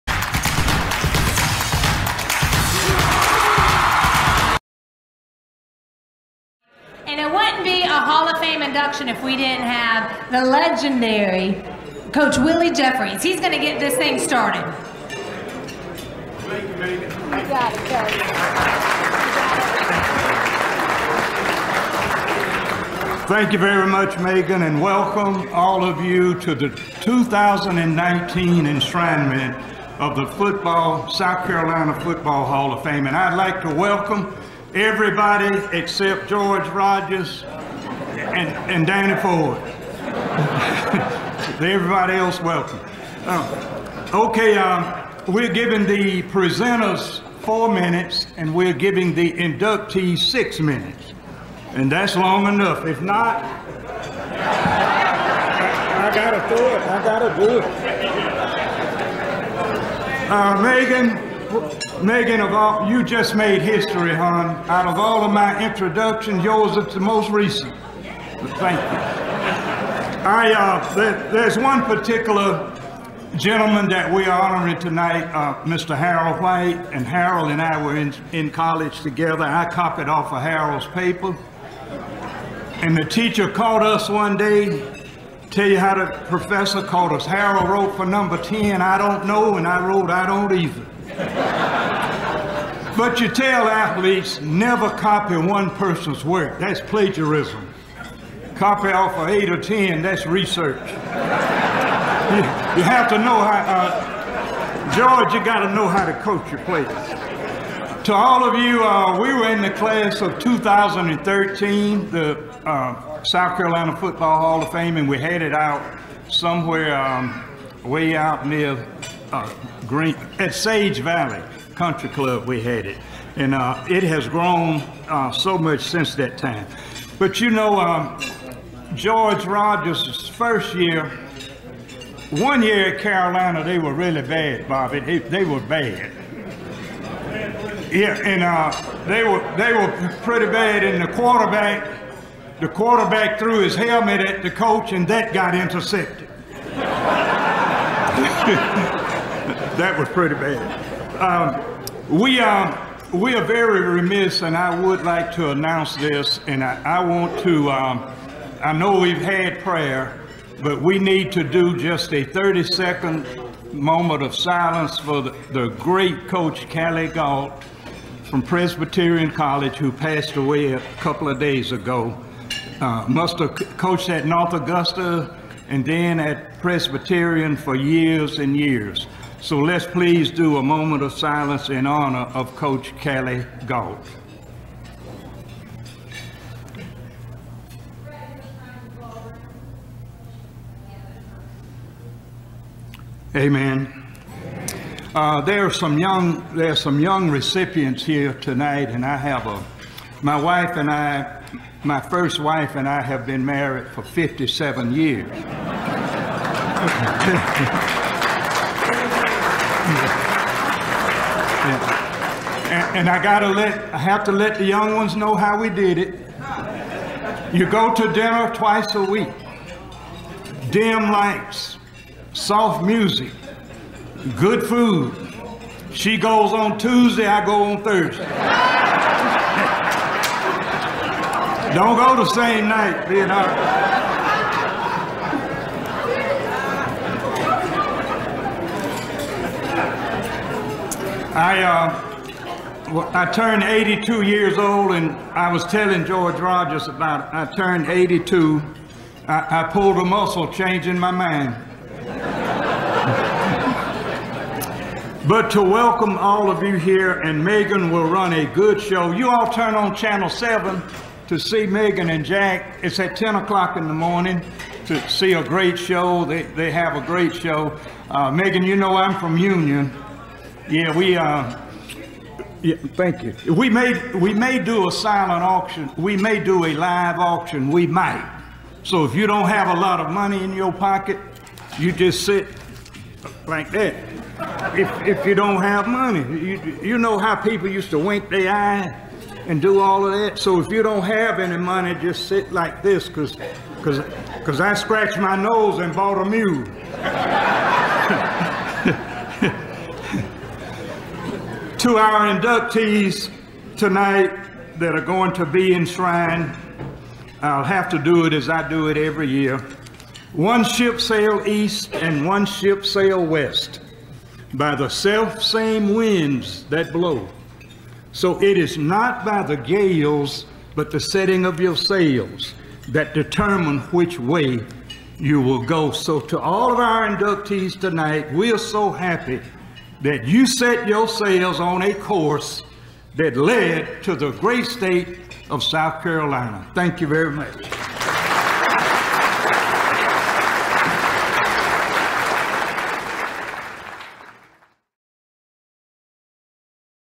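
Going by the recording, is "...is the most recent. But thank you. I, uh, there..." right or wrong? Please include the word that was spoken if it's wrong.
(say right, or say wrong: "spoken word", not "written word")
right.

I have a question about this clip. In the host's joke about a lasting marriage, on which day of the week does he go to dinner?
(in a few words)
Thursday.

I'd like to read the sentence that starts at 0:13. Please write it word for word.
He's going to get this thing started.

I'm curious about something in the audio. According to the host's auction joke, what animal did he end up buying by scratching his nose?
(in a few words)
a mule.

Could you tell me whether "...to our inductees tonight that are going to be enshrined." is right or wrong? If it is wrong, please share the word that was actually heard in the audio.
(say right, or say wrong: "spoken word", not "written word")
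right.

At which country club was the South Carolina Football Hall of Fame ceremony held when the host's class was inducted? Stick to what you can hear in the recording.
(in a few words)
Sage Valley Country Club.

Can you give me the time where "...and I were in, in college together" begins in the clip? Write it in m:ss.
1:17.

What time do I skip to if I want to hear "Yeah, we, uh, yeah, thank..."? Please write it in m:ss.
4:30.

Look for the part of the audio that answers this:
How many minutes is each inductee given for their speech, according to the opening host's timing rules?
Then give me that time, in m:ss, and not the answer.
0:50.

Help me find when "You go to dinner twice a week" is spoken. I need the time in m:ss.
3:37.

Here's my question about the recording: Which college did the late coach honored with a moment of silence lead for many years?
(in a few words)
Presbyterian College.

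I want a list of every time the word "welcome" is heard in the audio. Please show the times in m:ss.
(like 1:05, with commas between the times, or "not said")
0:24, 0:33, 0:42, 4:15.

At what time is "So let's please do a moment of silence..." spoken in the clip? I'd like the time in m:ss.
2:59.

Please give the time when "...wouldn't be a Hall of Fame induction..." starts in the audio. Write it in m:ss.
0:07.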